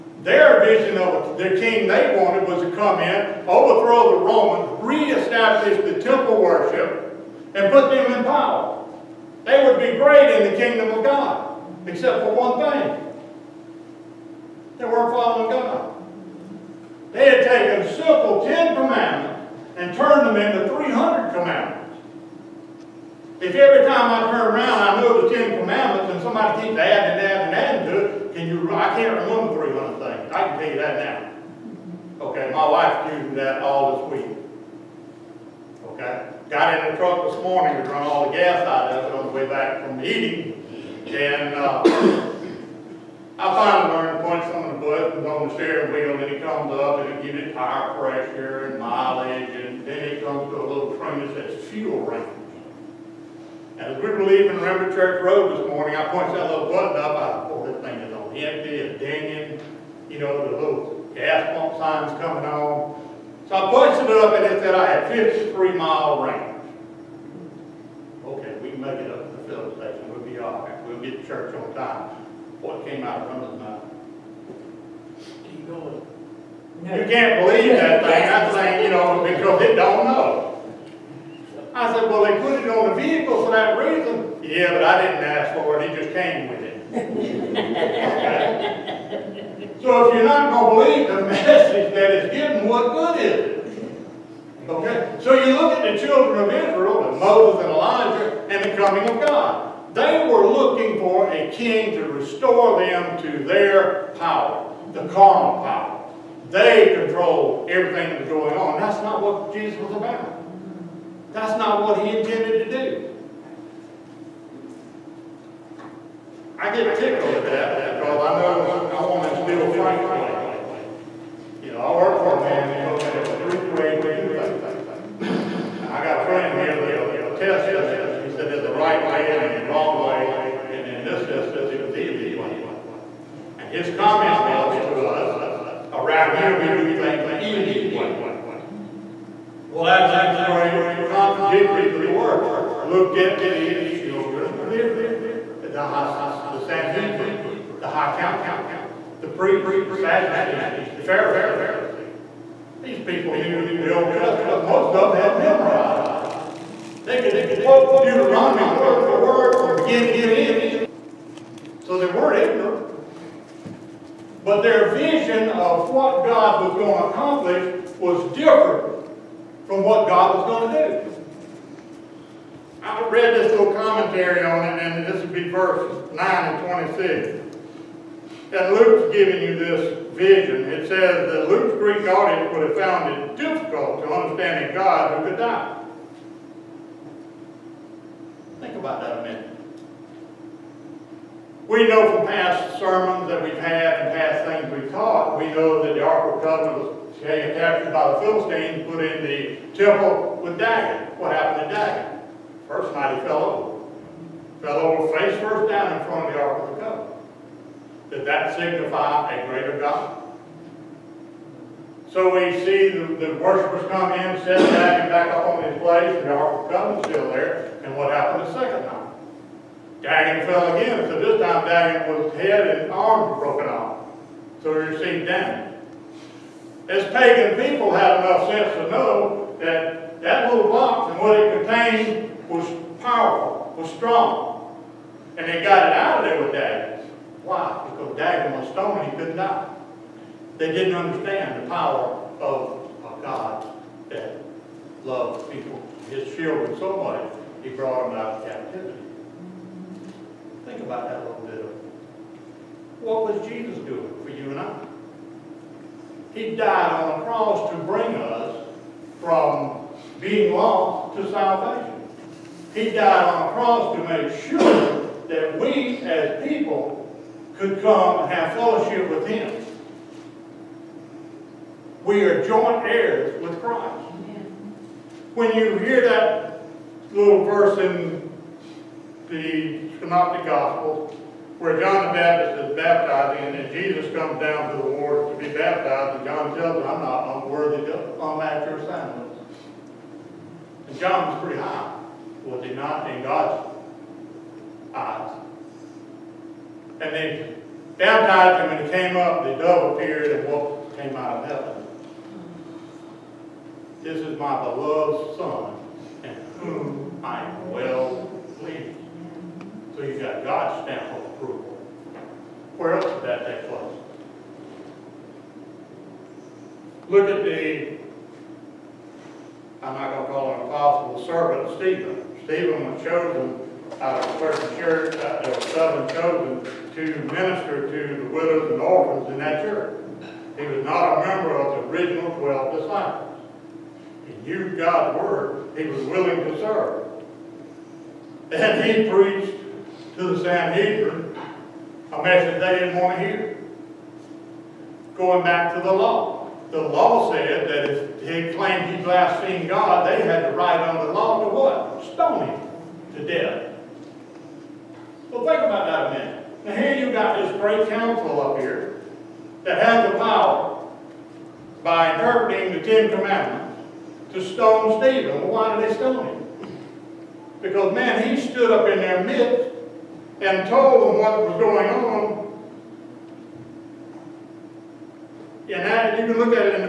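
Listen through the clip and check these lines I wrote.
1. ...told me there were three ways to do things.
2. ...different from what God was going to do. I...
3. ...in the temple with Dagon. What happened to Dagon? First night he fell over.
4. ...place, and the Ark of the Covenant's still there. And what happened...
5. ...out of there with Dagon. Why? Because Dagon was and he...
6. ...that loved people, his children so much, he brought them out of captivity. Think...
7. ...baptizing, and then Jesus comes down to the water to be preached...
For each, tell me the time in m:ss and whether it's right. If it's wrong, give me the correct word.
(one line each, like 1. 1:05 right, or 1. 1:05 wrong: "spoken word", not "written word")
1. 2:02 right
2. 2:48 right
3. 3:19 right
4. 3:35 right
5. 3:55 right
6. 4:04 right
7. 4:42 wrong: "baptized", not "preached".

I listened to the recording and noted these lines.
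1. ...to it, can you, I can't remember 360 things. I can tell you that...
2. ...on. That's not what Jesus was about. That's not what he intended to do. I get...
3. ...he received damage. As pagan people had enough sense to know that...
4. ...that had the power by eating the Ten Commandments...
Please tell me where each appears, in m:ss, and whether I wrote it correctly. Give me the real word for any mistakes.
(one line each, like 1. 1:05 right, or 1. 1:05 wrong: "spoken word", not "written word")
1. 0:27 wrong: "300", not "360"
2. 1:48 right
3. 3:44 right
4. 5:59 wrong: "interpreting", not "eating".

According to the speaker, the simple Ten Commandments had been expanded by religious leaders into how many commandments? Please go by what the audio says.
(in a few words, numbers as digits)
300.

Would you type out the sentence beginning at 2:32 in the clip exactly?
These people knew the Old Testament.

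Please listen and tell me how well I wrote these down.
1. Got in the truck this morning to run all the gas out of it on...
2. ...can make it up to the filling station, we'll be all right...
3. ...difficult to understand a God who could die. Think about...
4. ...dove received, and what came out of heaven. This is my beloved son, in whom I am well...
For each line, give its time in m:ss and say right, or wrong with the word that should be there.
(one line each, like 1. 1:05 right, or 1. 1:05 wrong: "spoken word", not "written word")
1. 0:36 right
2. 1:08 right
3. 3:03 right
4. 4:59 wrong: "appeared", not "received".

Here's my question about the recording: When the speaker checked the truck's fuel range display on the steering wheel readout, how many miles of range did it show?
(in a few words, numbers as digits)
53.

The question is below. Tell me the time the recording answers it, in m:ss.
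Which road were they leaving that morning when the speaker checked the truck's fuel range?
0:54.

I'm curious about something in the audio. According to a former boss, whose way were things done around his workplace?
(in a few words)
Ely's way.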